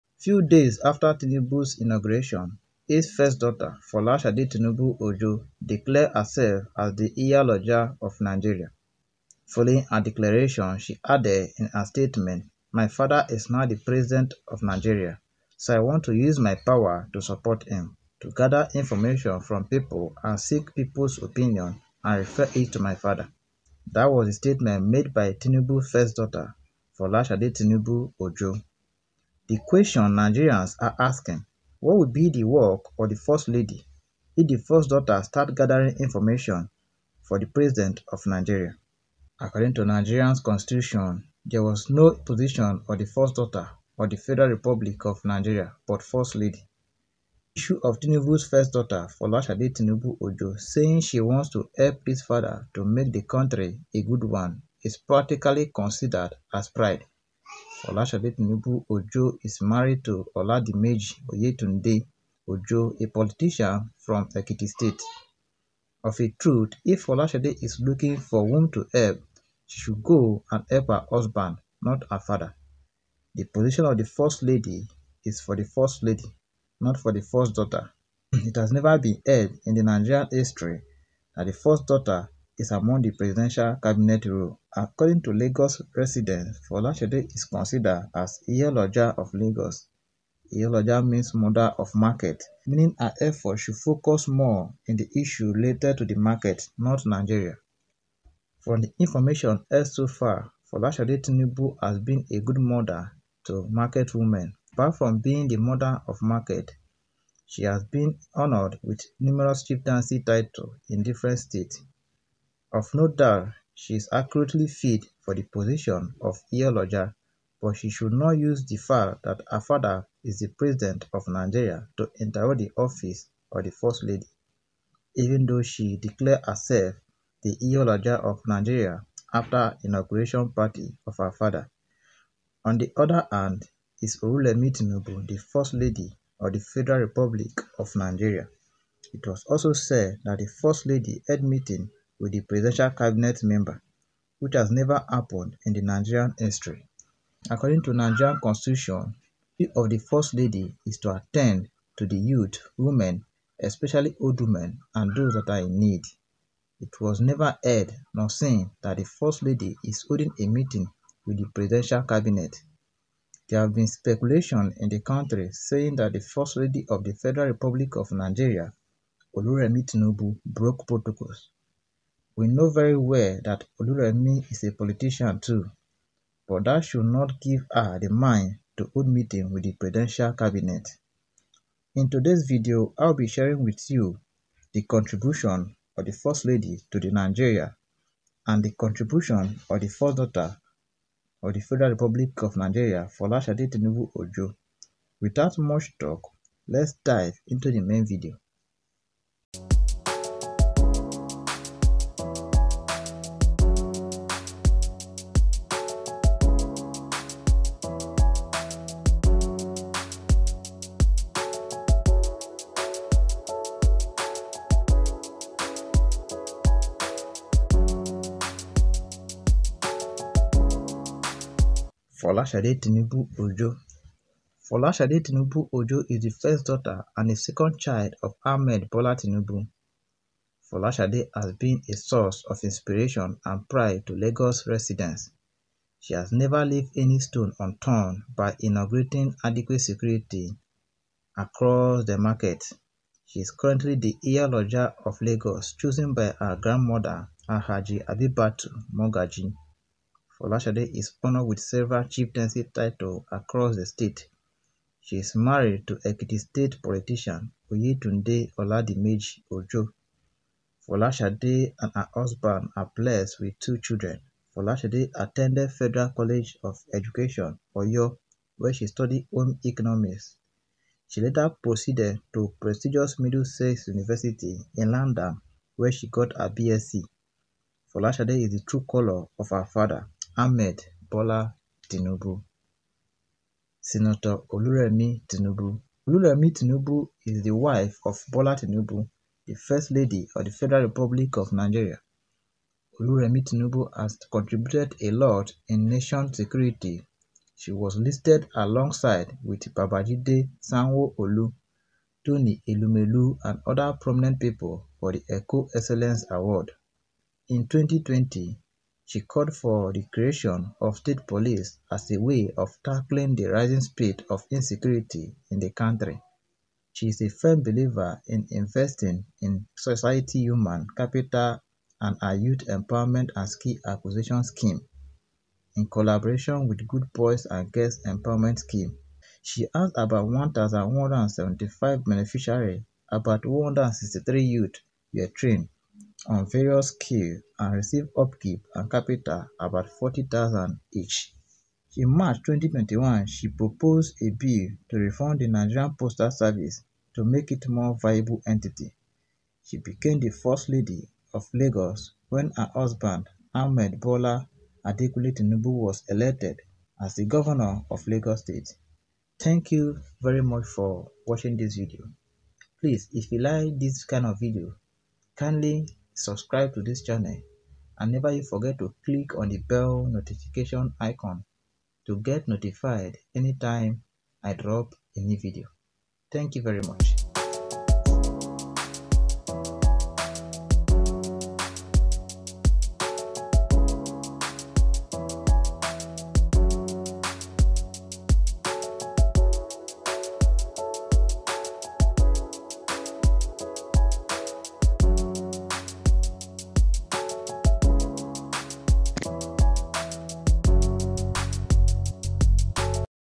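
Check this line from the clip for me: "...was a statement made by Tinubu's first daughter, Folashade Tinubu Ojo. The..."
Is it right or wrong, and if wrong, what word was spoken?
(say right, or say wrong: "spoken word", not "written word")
right.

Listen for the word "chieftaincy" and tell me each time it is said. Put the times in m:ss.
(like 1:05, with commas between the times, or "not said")
1:49, 4:12.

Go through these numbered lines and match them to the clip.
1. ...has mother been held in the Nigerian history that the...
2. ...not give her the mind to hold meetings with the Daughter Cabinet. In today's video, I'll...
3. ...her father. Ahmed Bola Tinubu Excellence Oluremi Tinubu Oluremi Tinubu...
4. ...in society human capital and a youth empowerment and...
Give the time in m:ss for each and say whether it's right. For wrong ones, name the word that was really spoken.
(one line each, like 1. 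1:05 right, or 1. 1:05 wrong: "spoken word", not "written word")
1. 1:18 wrong: "never", not "mother"
2. 2:57 wrong: "Presidential", not "Daughter"
3. 4:39 wrong: "Senator", not "Excellence"
4. 5:19 right.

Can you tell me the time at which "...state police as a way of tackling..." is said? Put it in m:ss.
5:10.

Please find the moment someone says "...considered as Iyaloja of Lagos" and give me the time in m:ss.
1:27.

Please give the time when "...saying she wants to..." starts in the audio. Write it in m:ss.
0:50.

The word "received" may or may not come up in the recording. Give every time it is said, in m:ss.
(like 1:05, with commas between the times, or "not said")
5:37.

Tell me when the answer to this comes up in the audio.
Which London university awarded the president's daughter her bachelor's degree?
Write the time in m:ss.
4:33.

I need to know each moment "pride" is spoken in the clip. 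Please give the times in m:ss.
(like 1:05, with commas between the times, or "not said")
0:56, 3:53.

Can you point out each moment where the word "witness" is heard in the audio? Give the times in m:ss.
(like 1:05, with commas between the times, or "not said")
not said.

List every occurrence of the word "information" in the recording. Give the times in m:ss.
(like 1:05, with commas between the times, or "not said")
0:18, 0:35, 1:38.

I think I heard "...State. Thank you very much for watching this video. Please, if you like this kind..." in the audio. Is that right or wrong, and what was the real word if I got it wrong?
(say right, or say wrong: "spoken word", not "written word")
right.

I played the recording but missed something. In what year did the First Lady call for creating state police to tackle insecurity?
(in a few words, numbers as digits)
2020.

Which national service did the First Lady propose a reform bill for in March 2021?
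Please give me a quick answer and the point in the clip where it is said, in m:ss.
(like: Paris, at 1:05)
Nigerian Postal Service, at 5:45.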